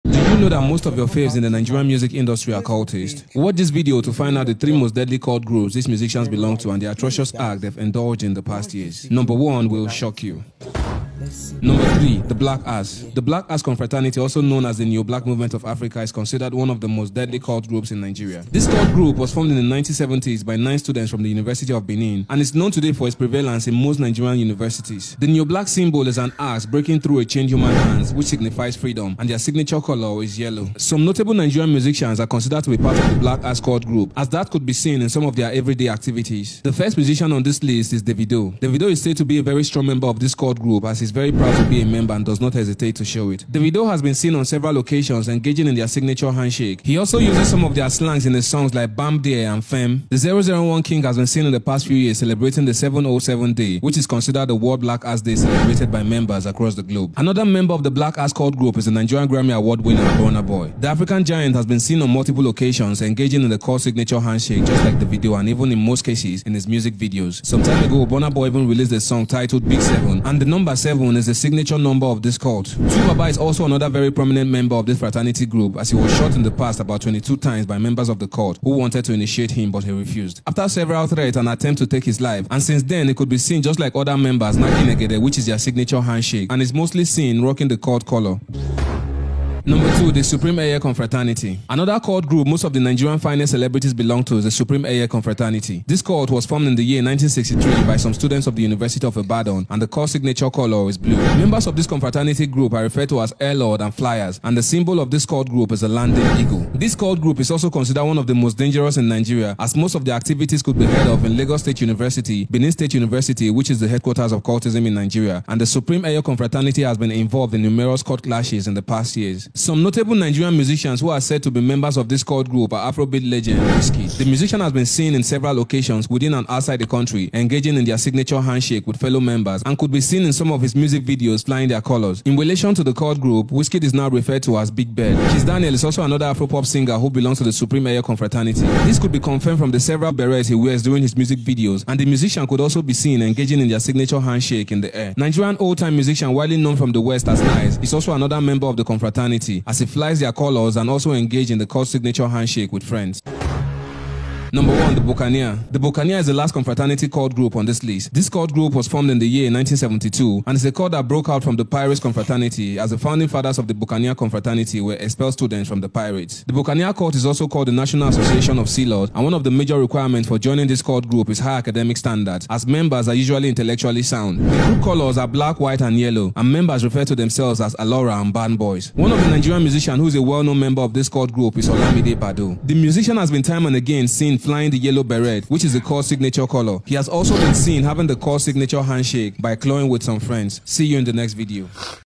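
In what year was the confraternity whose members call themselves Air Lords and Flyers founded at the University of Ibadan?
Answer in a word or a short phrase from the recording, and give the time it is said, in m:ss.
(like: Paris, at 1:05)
1963, at 1:37.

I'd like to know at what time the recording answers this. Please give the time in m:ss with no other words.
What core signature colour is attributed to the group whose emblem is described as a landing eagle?
1:40.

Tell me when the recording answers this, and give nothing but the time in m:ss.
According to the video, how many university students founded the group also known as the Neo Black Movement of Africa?
0:20.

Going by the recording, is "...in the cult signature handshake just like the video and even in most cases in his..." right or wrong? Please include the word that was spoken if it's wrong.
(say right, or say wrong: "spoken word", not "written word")
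right.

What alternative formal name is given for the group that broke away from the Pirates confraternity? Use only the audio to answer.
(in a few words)
National Association of Sea Lords.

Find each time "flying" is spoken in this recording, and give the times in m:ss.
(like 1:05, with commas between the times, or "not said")
2:11, 3:04.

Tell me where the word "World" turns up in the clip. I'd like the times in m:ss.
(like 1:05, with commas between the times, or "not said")
0:54.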